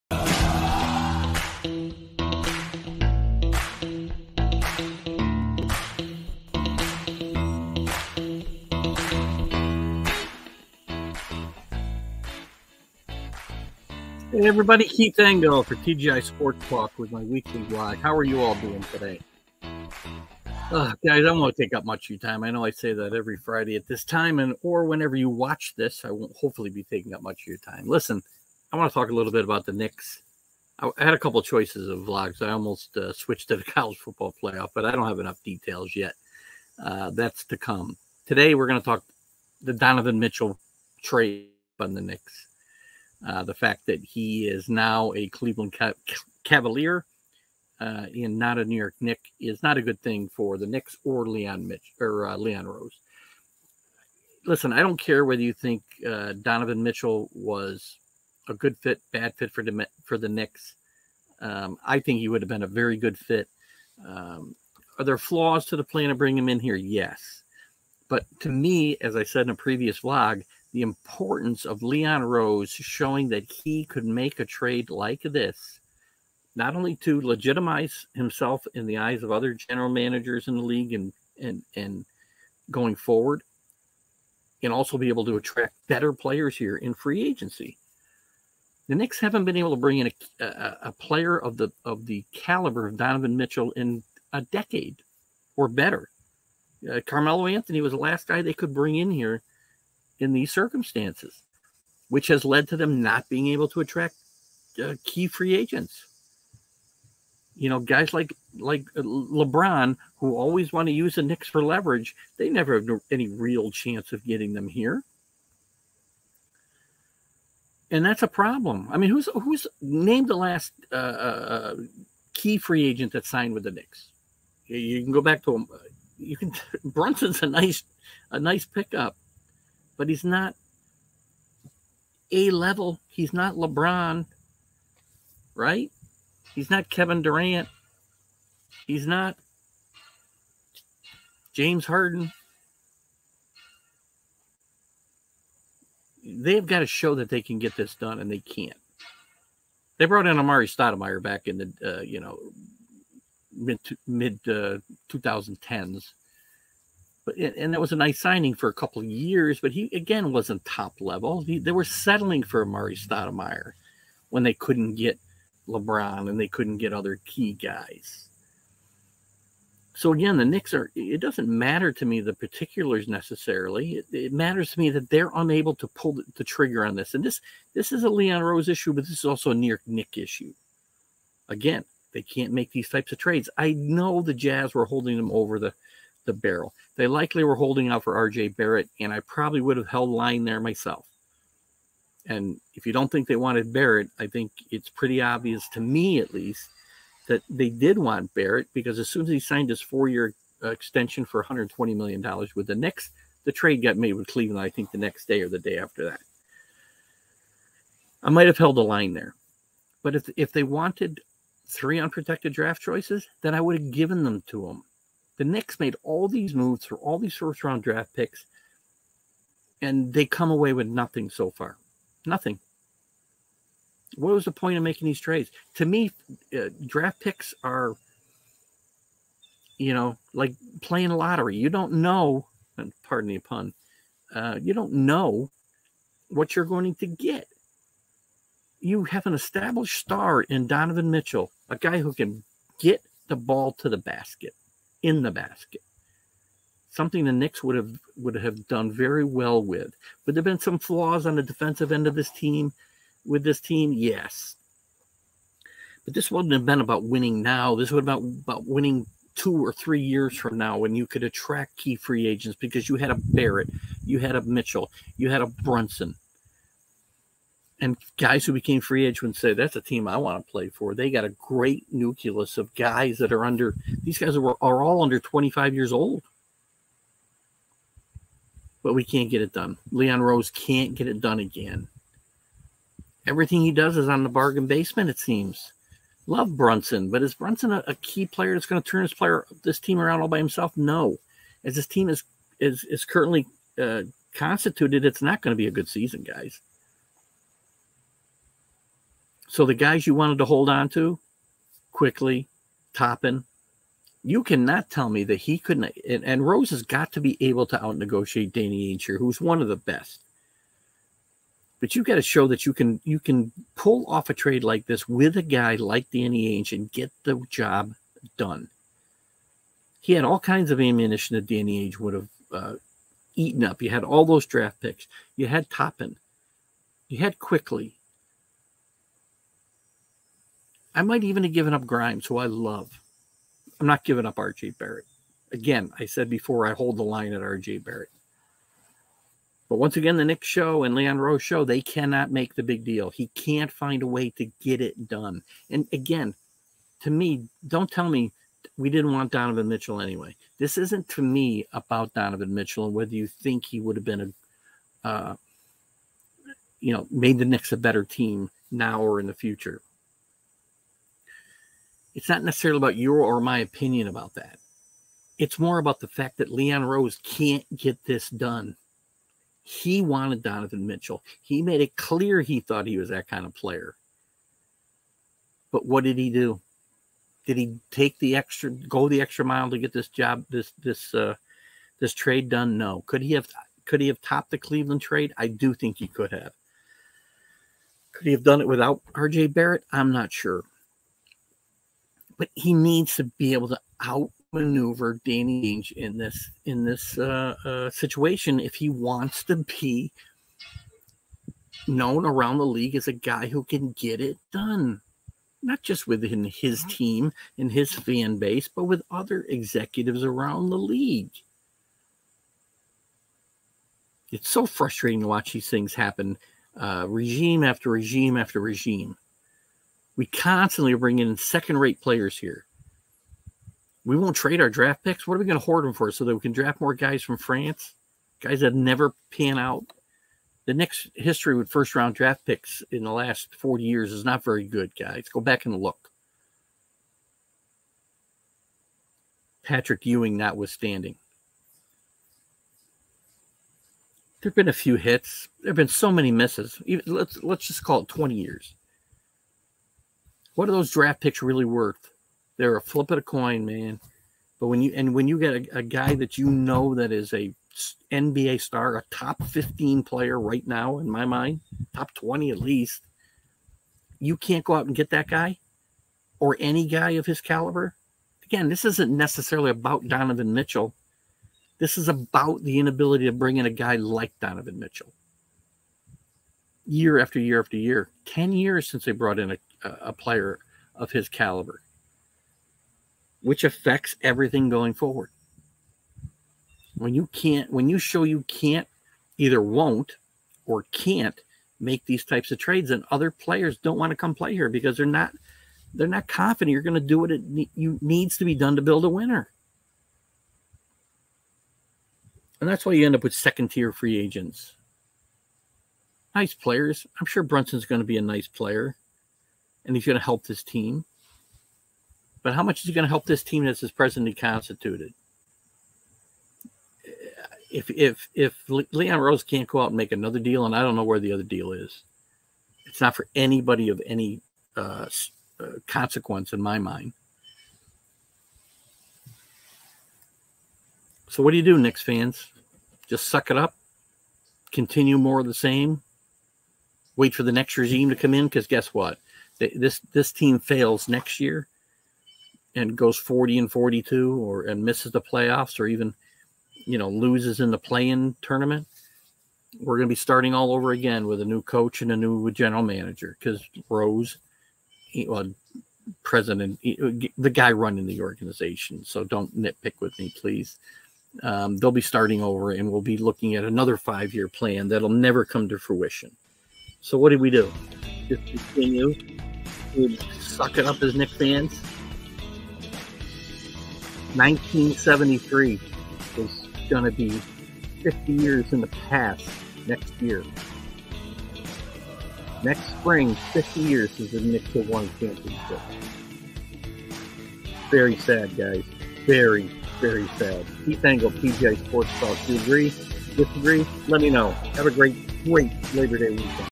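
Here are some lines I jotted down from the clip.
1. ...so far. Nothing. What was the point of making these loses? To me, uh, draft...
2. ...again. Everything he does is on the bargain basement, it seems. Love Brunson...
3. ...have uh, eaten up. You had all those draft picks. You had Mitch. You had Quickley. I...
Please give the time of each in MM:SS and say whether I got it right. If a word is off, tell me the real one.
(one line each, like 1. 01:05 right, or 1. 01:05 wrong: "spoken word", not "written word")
1. 03:41 wrong: "trades", not "loses"
2. 04:41 right
3. 05:22 wrong: "Toppin", not "Mitch".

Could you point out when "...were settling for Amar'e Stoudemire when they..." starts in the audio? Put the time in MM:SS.
02:41.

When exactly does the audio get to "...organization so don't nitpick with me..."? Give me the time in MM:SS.
09:18.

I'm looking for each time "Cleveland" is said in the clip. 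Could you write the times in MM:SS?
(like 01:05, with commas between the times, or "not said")
00:45, 03:24, 06:24.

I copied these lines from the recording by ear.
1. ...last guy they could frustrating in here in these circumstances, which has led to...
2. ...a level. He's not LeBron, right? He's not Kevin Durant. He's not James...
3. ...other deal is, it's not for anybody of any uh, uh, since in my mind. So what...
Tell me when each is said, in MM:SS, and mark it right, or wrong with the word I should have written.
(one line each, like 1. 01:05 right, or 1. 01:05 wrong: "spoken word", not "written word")
1. 01:37 wrong: "bring", not "frustrating"
2. 02:12 right
3. 08:41 wrong: "consequence", not "since".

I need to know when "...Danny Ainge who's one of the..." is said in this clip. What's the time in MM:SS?
05:08.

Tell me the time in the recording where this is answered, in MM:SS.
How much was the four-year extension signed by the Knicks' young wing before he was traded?
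03:21.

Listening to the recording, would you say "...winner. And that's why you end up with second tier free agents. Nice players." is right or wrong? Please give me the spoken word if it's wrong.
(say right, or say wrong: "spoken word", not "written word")
right.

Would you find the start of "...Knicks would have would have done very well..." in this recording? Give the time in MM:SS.
04:07.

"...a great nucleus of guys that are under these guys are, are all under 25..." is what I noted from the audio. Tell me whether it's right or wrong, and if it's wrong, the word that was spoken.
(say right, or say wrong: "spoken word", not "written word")
right.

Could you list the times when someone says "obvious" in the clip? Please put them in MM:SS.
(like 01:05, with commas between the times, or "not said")
03:15.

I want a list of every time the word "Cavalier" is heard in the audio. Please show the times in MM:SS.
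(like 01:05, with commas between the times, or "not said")
00:46.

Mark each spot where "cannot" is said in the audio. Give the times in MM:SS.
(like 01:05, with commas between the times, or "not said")
05:04, 05:41.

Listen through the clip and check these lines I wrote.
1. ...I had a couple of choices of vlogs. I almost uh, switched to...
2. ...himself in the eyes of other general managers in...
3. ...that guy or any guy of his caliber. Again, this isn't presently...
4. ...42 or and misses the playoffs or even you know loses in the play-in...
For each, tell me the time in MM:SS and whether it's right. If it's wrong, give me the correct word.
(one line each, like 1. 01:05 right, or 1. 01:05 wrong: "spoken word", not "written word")
1. 00:30 right
2. 01:18 right
3. 07:45 wrong: "necessarily", not "presently"
4. 09:03 right.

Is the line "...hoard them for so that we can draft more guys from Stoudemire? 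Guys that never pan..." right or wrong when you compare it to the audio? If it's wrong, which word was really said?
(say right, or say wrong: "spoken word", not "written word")
wrong: "France", not "Stoudemire".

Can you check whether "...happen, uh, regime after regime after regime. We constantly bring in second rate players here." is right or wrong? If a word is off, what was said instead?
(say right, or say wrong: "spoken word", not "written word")
right.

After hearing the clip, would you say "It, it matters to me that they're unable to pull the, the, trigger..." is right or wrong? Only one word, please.
right.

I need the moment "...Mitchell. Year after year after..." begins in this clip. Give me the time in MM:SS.
07:54.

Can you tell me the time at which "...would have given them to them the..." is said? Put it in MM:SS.
03:33.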